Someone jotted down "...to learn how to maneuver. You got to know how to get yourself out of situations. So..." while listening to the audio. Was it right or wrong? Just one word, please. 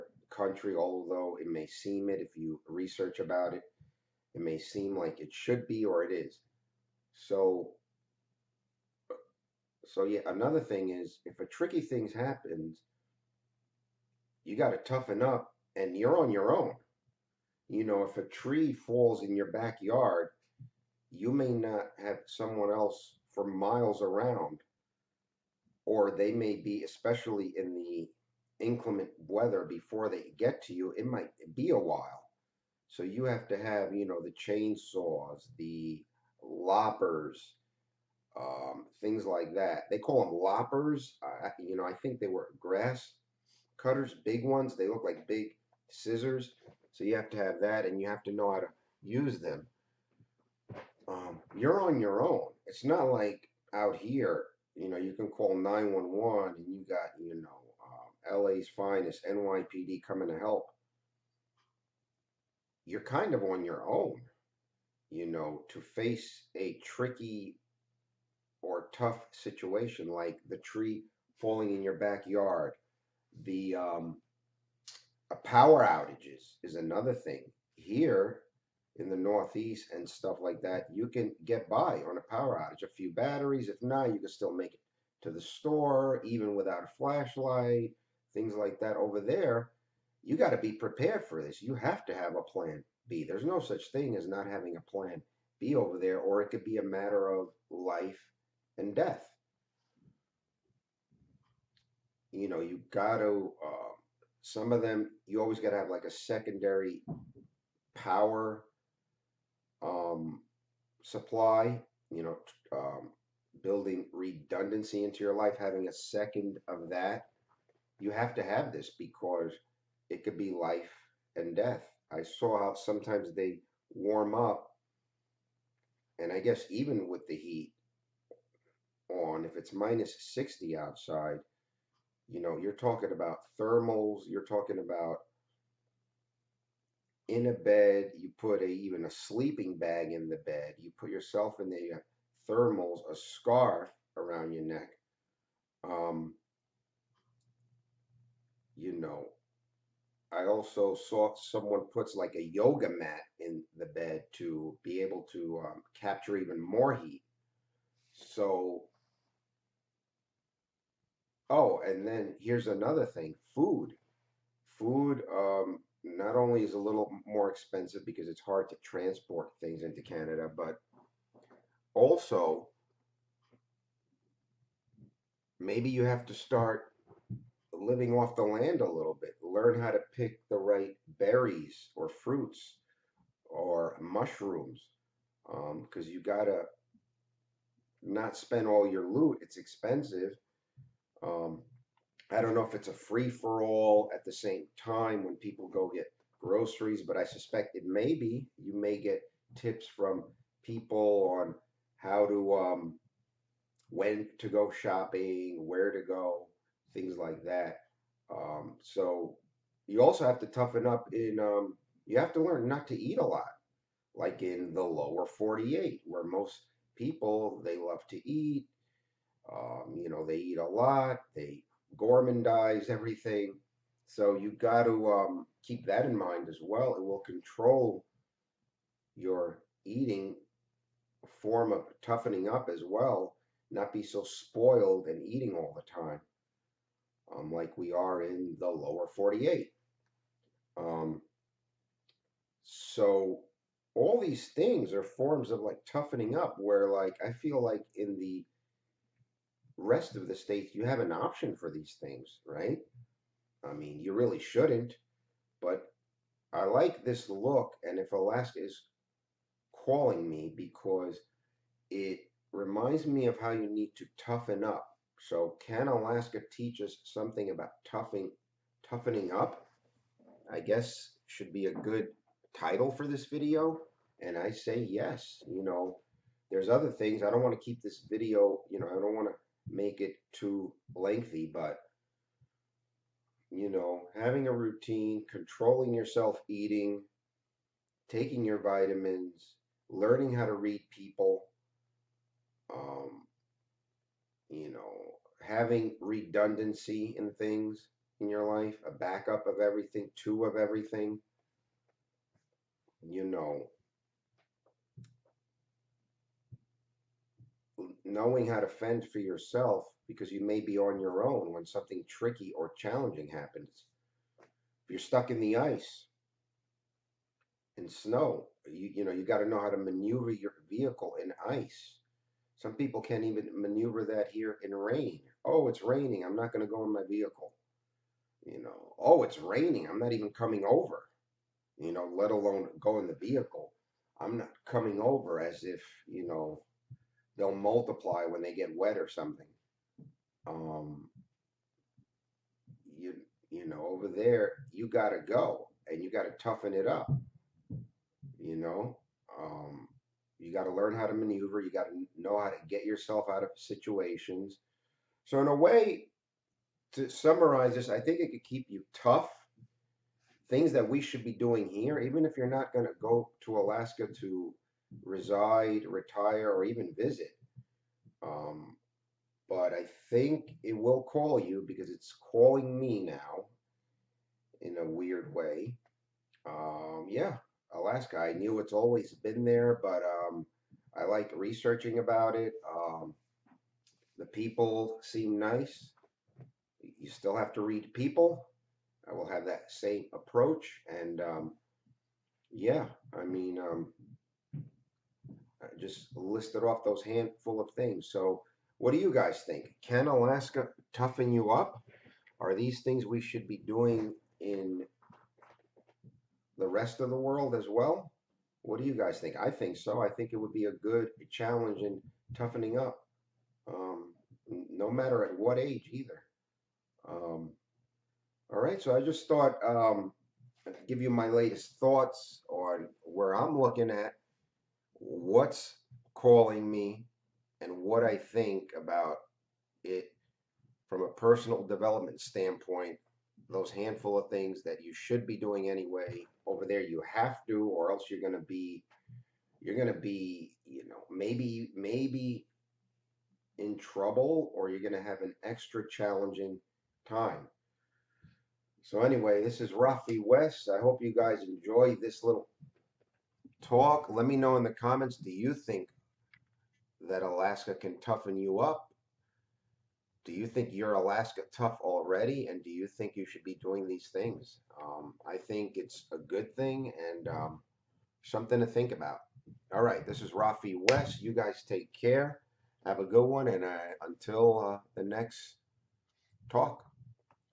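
right.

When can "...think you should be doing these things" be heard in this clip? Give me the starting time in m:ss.
7:42.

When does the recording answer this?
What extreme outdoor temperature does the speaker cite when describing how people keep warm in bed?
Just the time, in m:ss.
2:09.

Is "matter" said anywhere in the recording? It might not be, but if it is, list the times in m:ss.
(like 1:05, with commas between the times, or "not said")
1:36, 6:54.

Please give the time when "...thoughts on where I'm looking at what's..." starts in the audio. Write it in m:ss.
7:01.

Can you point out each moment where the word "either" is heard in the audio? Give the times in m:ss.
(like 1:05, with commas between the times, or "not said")
6:55.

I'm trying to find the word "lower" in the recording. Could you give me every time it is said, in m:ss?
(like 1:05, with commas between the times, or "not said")
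3:34, 3:58.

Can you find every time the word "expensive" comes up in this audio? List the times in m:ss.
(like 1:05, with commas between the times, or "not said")
2:47, 3:09.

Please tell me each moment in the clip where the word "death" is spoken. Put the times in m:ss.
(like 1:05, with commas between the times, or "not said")
1:38, 2:01.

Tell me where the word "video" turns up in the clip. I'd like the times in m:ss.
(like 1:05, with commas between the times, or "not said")
4:33, 4:38.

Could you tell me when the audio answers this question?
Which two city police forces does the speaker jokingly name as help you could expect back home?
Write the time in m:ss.
0:58.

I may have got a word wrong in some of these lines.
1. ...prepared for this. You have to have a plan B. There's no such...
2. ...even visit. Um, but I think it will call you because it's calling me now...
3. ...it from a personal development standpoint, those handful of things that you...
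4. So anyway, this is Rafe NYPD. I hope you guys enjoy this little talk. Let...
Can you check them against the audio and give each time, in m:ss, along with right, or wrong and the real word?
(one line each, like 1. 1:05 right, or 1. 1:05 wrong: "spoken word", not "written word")
1. 1:30 right
2. 6:06 right
3. 7:09 right
4. 7:28 wrong: "West", not "NYPD".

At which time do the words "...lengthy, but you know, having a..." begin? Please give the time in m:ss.
4:40.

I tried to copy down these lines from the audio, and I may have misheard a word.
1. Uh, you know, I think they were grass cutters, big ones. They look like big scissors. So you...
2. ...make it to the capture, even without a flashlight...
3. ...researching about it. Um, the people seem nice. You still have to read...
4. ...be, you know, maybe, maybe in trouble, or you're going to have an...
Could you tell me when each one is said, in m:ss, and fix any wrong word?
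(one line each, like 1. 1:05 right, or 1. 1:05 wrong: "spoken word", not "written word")
1. 0:41 right
2. 1:24 wrong: "store", not "capture"
3. 6:21 right
4. 7:19 right.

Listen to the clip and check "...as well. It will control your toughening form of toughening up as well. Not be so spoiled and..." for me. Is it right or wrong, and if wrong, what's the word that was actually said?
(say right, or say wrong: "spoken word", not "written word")
wrong: "eating", not "toughening".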